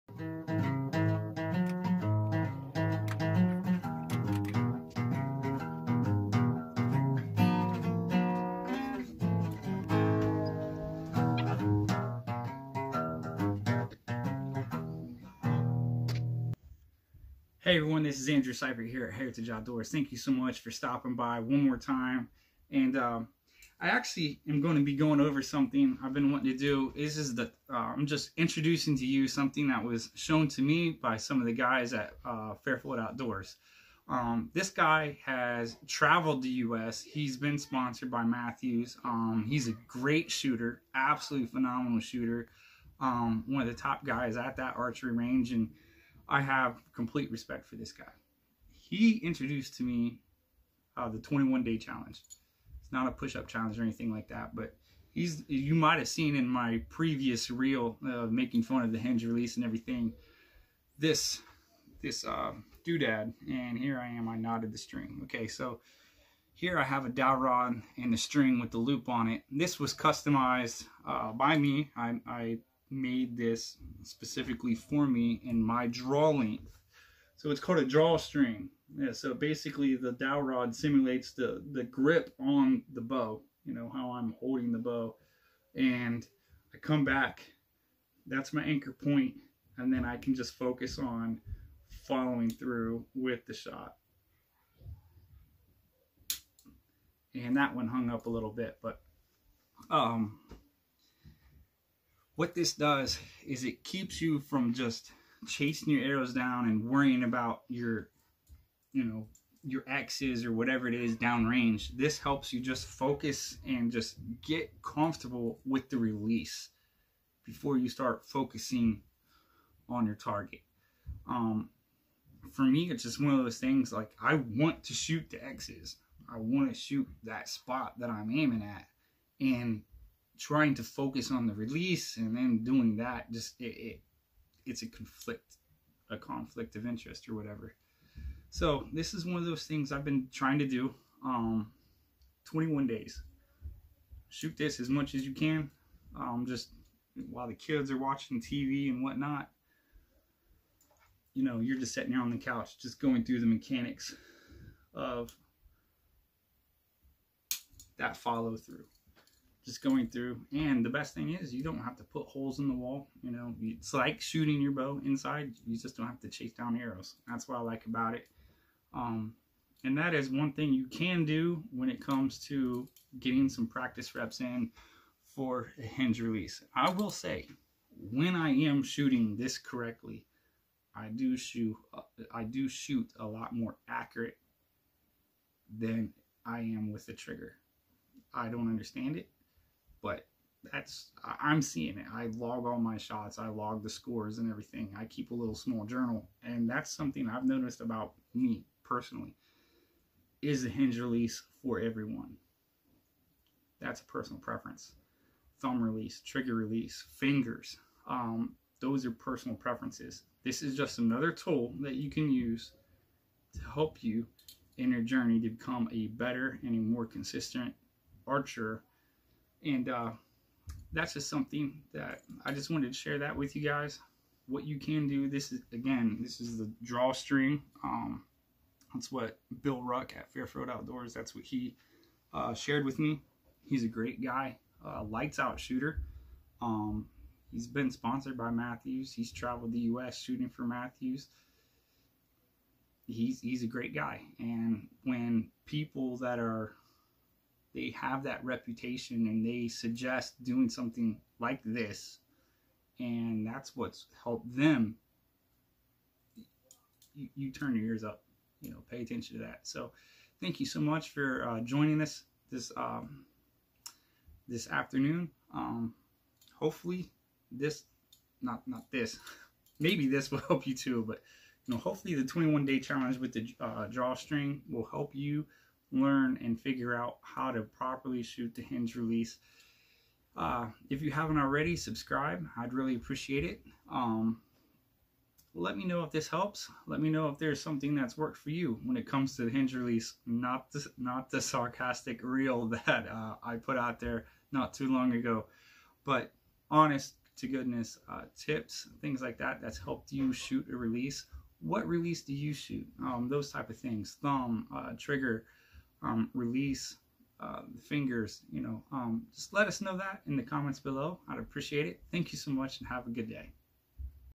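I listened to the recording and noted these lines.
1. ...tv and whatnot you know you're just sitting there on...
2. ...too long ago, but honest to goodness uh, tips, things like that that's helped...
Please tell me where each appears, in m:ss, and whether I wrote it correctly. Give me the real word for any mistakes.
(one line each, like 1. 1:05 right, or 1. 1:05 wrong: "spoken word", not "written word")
1. 2:28 right
2. 4:54 right.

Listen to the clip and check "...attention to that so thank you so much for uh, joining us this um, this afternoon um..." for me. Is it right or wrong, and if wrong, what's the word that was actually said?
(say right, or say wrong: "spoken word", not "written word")
right.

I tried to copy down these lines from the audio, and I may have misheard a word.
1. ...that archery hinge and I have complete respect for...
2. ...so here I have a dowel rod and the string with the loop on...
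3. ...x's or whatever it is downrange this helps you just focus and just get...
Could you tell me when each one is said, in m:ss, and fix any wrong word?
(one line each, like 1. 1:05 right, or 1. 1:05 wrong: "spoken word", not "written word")
1. 0:44 wrong: "range", not "hinge"
2. 1:05 right
3. 1:49 right.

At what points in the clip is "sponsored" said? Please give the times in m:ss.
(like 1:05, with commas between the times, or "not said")
0:37, 3:57.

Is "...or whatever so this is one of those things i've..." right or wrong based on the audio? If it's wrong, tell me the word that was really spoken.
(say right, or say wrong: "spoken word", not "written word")
right.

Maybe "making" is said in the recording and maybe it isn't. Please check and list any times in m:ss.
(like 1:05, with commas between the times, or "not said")
0:58.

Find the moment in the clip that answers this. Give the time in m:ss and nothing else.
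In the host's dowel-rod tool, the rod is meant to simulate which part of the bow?
1:21.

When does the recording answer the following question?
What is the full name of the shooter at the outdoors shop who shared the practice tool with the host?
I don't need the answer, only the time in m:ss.
3:49.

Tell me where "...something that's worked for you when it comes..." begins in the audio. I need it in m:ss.
4:47.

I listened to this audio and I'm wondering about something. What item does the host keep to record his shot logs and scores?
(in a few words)
small journal.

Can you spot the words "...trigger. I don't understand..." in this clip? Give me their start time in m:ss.
3:07.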